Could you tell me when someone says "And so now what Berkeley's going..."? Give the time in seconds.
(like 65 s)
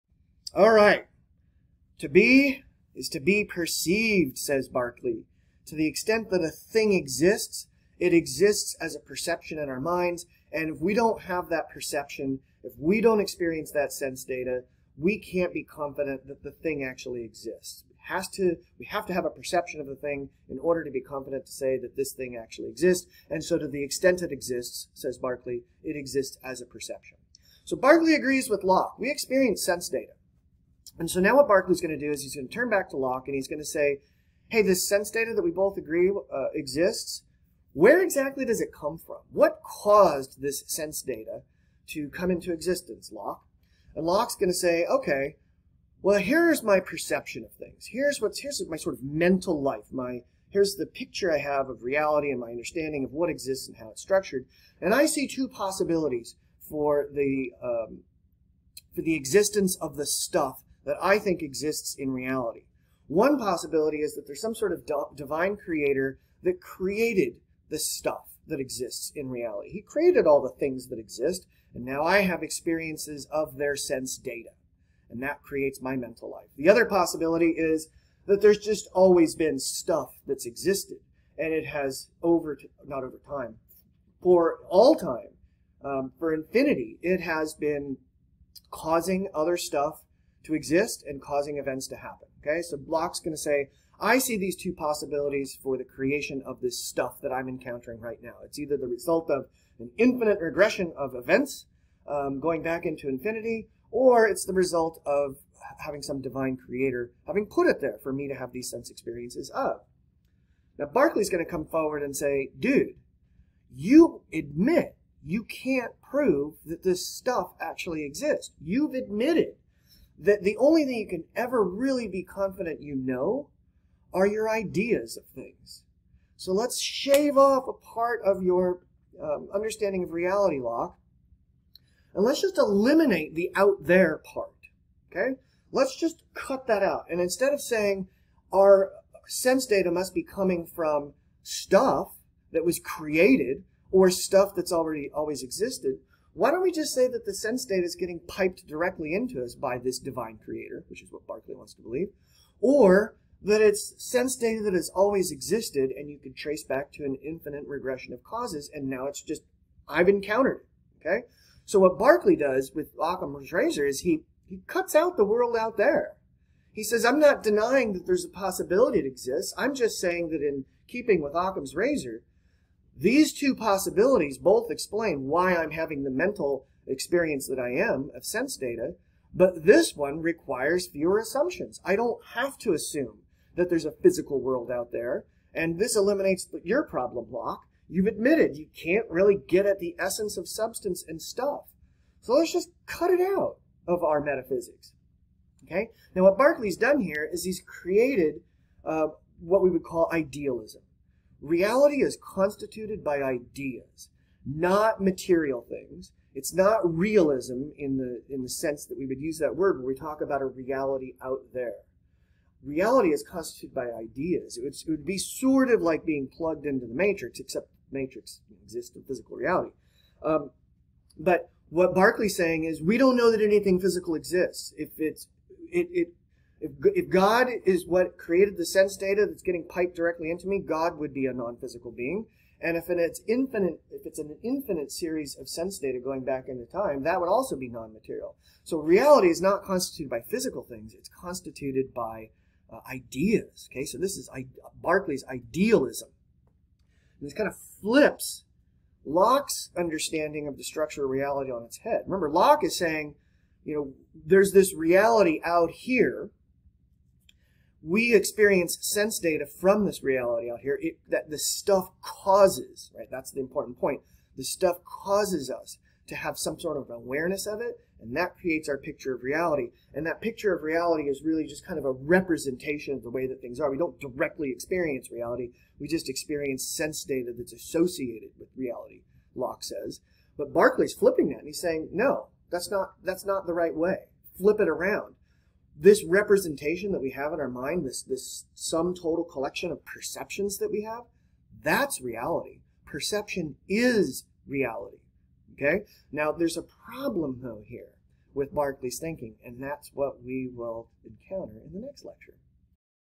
30 s.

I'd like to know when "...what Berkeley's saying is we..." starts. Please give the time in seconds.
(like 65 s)
221 s.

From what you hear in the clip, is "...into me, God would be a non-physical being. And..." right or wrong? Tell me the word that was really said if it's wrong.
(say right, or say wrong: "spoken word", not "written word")
right.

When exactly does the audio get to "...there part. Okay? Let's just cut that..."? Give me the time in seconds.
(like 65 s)
133 s.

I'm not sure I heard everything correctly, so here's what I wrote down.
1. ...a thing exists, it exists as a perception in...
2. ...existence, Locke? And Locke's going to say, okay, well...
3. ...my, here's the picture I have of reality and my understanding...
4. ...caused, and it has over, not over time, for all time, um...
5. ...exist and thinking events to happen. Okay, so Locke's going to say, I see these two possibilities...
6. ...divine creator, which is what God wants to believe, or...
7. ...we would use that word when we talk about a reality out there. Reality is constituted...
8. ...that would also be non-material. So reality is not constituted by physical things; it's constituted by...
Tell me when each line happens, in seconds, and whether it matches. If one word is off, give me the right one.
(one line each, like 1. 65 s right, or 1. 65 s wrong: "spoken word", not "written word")
1. 6 s right
2. 42 s right
3. 49 s right
4. 80 s wrong: "existed", not "caused"
5. 90 s wrong: "causing", not "thinking"
6. 149 s wrong: "Berkeley", not "God"
7. 208 s right
8. 237 s right.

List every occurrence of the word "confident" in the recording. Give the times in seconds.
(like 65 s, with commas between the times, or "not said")
15 s, 20 s, 122 s.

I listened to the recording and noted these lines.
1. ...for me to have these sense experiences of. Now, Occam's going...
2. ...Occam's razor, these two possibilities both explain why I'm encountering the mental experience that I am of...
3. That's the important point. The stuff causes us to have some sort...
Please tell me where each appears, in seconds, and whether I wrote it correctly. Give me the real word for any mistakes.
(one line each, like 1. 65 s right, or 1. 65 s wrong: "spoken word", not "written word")
1. 108 s wrong: "Berkeley", not "Occam"
2. 171 s wrong: "having", not "encountering"
3. 263 s right.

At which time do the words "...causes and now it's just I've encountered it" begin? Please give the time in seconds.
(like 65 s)
158 s.